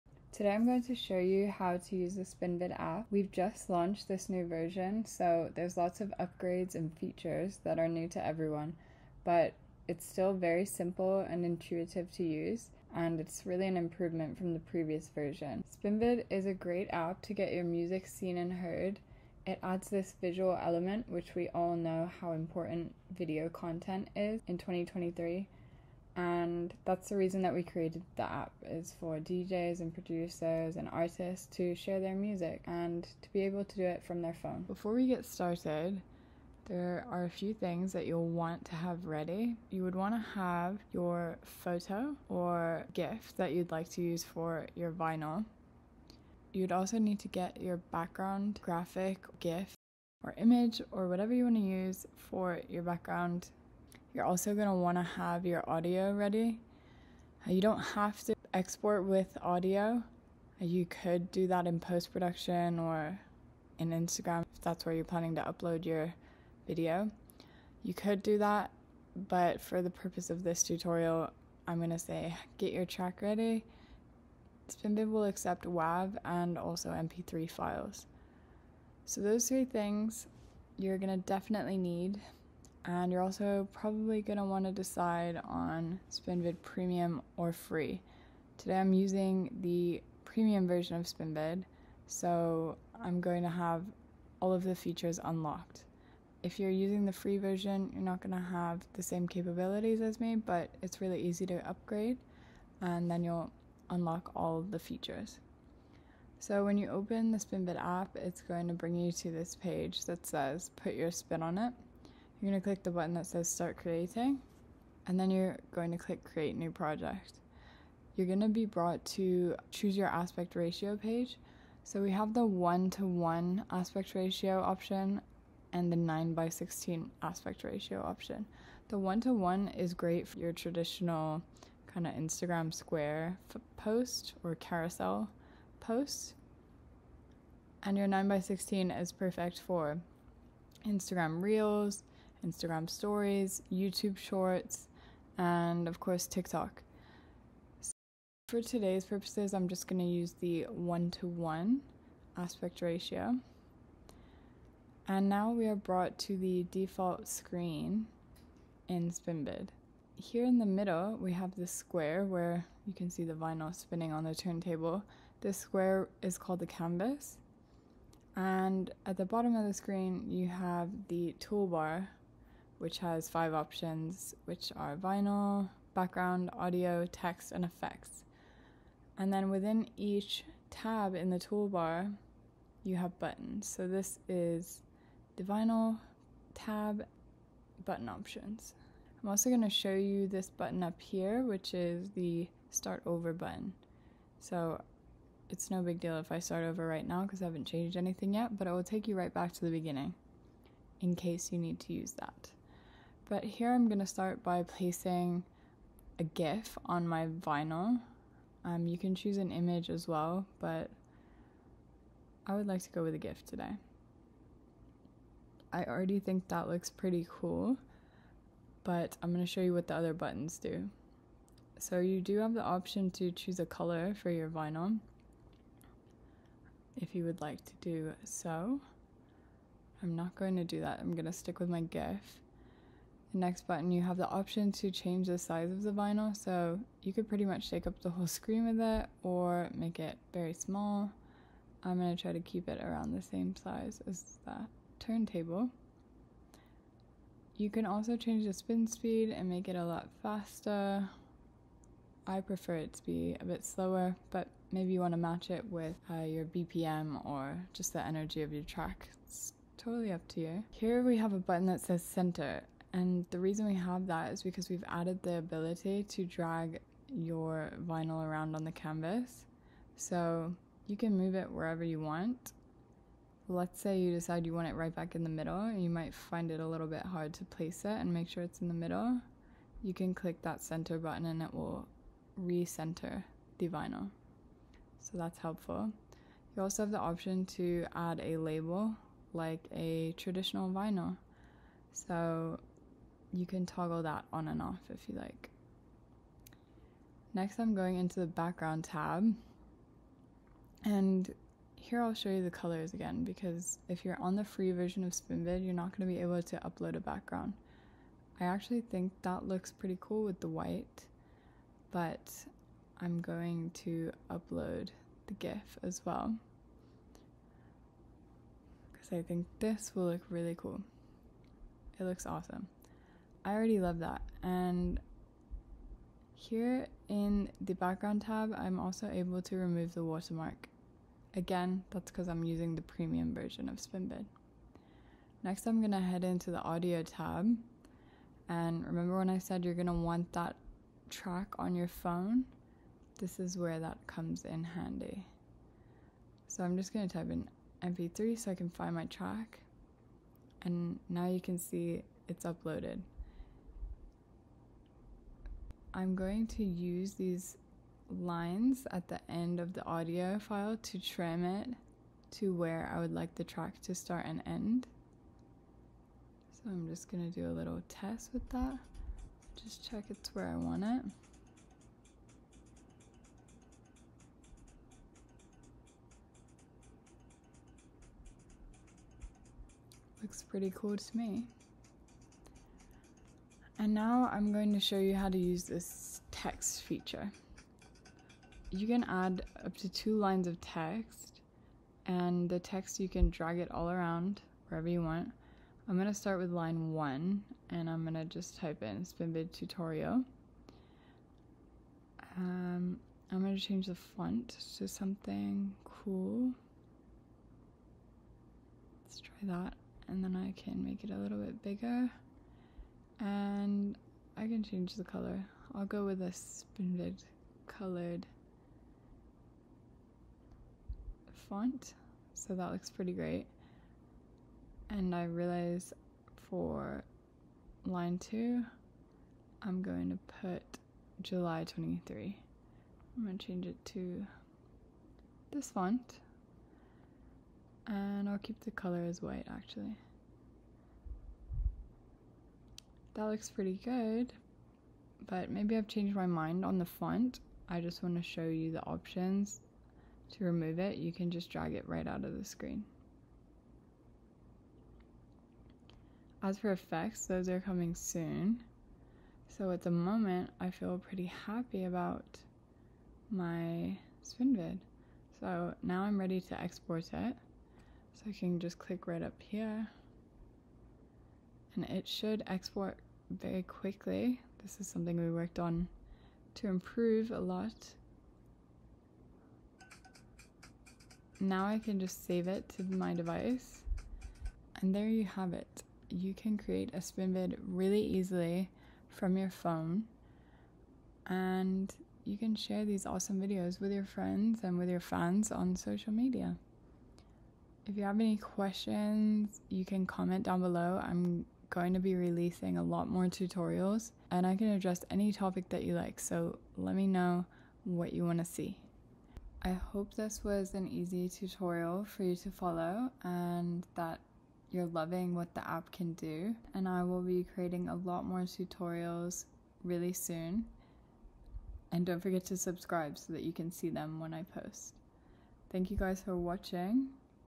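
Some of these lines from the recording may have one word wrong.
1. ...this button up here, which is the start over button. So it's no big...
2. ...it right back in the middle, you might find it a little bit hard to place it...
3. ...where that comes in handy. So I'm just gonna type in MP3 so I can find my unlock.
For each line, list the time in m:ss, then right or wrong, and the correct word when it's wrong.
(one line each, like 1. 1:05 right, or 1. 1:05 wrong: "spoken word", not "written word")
1. 3:10 right
2. 4:34 right
3. 5:43 wrong: "track", not "unlock".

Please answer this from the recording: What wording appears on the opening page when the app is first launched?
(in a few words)
put your spin on it.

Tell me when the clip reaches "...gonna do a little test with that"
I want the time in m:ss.
6:07.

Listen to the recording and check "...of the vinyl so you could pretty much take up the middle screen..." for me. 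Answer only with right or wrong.
wrong.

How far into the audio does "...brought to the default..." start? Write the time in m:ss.
2:35.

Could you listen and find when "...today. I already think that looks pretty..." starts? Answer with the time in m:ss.
3:33.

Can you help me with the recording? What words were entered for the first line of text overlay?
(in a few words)
SpinVid tutorial.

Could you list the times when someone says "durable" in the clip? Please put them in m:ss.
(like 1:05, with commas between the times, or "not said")
not said.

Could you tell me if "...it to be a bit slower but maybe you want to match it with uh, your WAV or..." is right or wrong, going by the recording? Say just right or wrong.
wrong.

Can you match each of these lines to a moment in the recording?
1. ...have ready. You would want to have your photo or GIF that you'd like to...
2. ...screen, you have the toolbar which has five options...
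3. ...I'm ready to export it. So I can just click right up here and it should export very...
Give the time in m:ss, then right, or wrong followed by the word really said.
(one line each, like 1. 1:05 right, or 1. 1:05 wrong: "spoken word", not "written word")
1. 0:38 right
2. 2:49 right
3. 7:46 right.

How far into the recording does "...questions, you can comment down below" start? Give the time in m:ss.
8:18.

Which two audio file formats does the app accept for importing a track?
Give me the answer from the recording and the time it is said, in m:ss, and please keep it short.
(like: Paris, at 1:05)
WAV and MP3, at 1:15.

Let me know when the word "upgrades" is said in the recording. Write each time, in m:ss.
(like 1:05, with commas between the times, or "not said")
0:06, 1:41.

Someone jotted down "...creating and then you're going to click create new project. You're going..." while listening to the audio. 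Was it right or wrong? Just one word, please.
right.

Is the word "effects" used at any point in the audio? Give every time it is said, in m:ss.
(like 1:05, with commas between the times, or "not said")
2:57, 7:36.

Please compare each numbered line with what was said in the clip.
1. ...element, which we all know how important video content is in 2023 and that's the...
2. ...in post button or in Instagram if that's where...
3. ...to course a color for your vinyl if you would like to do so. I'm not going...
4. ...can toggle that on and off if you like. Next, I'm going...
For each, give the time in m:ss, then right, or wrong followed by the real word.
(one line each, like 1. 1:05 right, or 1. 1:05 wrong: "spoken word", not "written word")
1. 0:20 right
2. 1:01 wrong: "production", not "button"
3. 3:43 wrong: "choose", not "course"
4. 4:53 right.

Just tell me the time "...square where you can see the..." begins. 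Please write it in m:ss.
2:41.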